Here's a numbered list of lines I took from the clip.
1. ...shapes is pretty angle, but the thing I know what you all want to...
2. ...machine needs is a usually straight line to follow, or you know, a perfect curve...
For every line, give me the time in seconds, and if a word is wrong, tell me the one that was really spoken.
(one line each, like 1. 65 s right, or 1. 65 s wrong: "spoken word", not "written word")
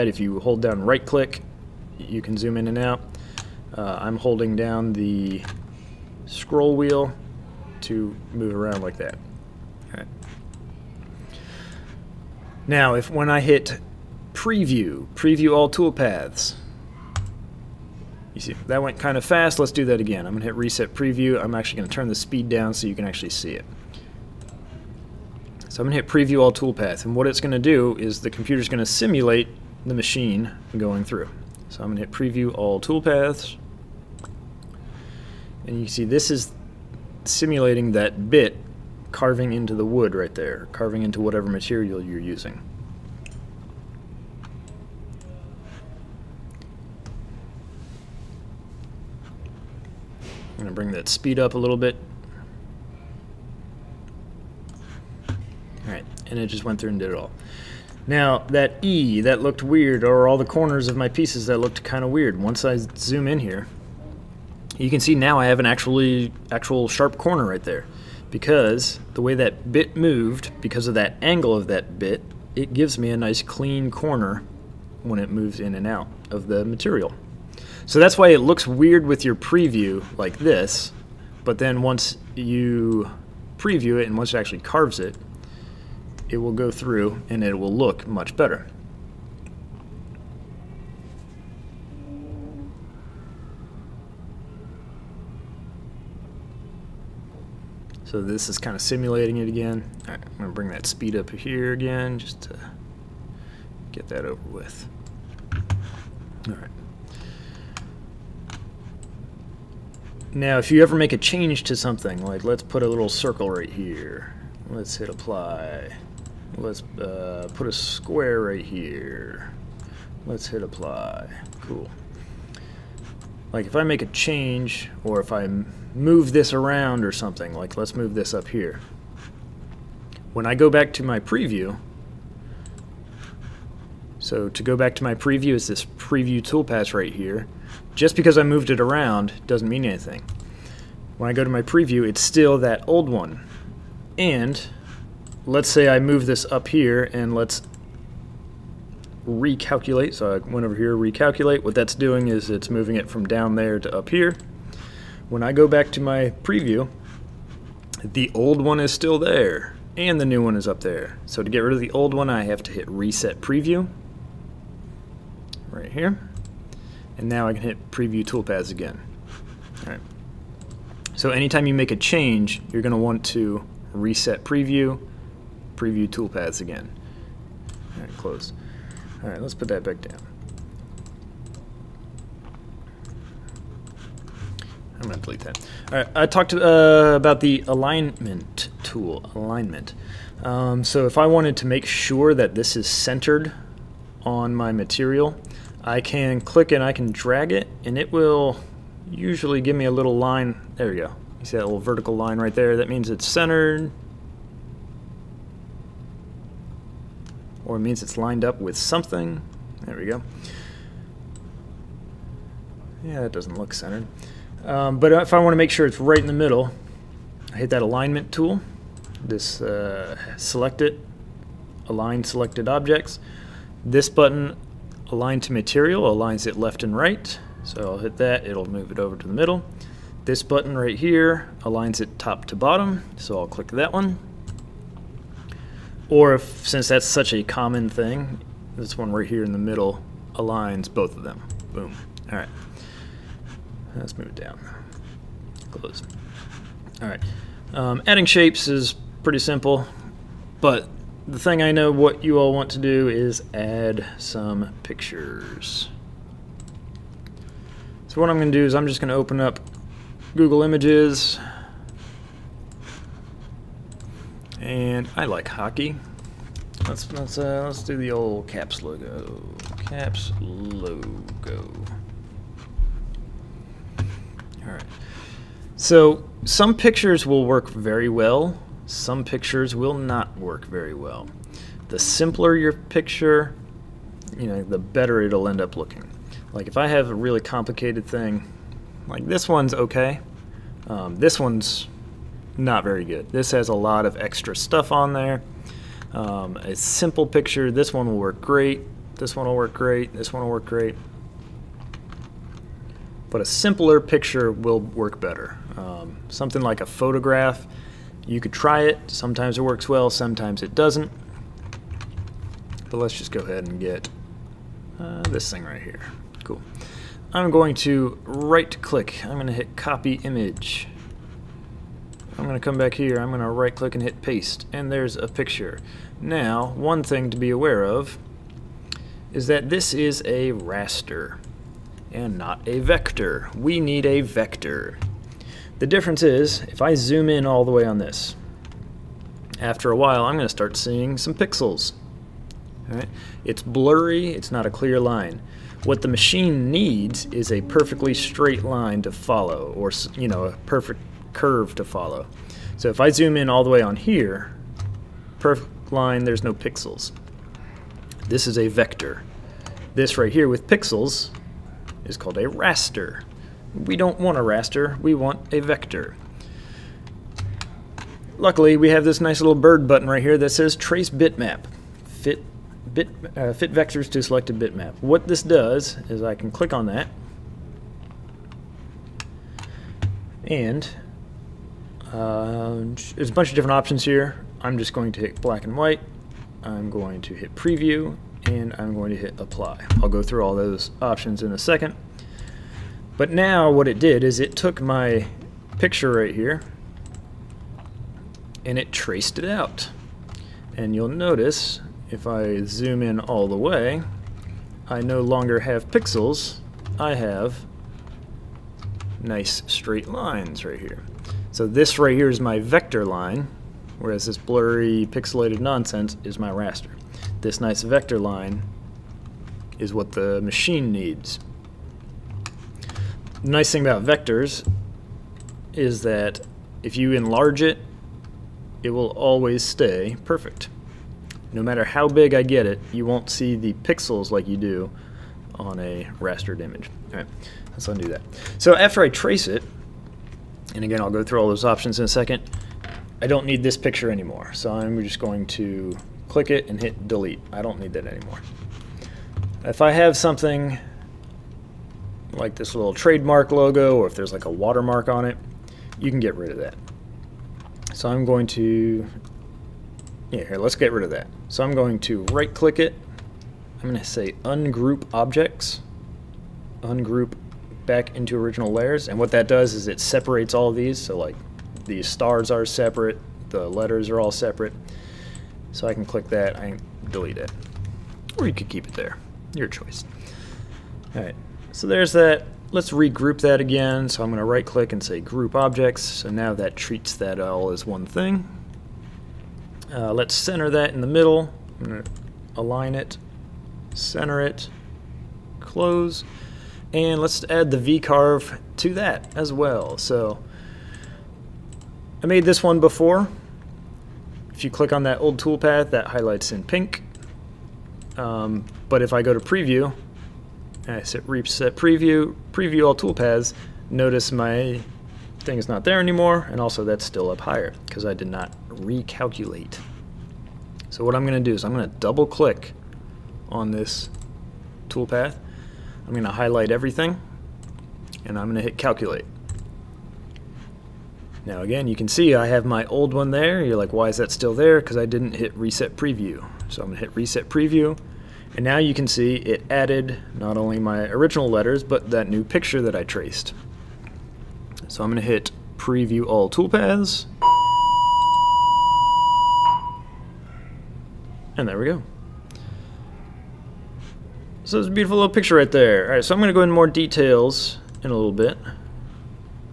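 1. 248 s wrong: "simple", not "angle"
2. 346 s wrong: "perfectly", not "usually".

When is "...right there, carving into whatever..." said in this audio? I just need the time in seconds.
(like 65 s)
40 s.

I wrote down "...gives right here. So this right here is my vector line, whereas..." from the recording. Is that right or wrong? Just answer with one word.
wrong.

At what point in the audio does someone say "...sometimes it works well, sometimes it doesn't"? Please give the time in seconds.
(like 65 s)
309 s.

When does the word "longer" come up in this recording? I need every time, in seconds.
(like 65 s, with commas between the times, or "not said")
405 s.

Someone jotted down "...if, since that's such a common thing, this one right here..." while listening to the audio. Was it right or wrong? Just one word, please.
right.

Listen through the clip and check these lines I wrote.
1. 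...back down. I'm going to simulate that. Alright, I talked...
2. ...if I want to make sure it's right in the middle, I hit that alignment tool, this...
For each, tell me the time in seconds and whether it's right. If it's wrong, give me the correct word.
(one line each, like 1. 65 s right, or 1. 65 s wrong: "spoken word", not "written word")
1. 179 s wrong: "delete", not "simulate"
2. 215 s right.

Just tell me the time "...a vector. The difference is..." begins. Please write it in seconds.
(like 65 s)
334 s.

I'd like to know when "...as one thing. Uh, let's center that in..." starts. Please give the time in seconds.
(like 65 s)
487 s.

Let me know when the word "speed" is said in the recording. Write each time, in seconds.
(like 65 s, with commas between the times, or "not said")
22 s, 51 s, 100 s.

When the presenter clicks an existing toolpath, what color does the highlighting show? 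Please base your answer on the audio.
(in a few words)
Pink.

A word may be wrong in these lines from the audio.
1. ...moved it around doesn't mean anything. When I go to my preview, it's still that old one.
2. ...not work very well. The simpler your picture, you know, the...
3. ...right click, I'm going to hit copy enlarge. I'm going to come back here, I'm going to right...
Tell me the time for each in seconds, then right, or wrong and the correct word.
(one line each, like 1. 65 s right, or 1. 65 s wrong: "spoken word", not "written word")
1. 138 s right
2. 279 s right
3. 318 s wrong: "image", not "enlarge".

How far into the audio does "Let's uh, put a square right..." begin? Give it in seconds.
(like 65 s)
116 s.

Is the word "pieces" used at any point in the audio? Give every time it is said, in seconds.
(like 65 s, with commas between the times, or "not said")
61 s.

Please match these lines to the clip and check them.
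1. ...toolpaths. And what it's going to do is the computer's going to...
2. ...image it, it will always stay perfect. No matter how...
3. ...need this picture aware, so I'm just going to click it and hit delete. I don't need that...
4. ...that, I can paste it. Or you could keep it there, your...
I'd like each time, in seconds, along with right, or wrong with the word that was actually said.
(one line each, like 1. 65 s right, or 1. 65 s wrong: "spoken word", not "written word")
1. 26 s right
2. 427 s wrong: "enlarge", not "image"
3. 443 s wrong: "anymore", not "aware"
4. 476 s wrong: "delete", not "paste".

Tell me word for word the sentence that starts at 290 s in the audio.
Um, this one's not very good.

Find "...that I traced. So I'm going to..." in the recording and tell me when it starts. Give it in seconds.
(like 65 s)
542 s.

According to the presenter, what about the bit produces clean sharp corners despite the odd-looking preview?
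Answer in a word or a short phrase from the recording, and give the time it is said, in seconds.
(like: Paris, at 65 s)
Angle of that bit, at 71 s.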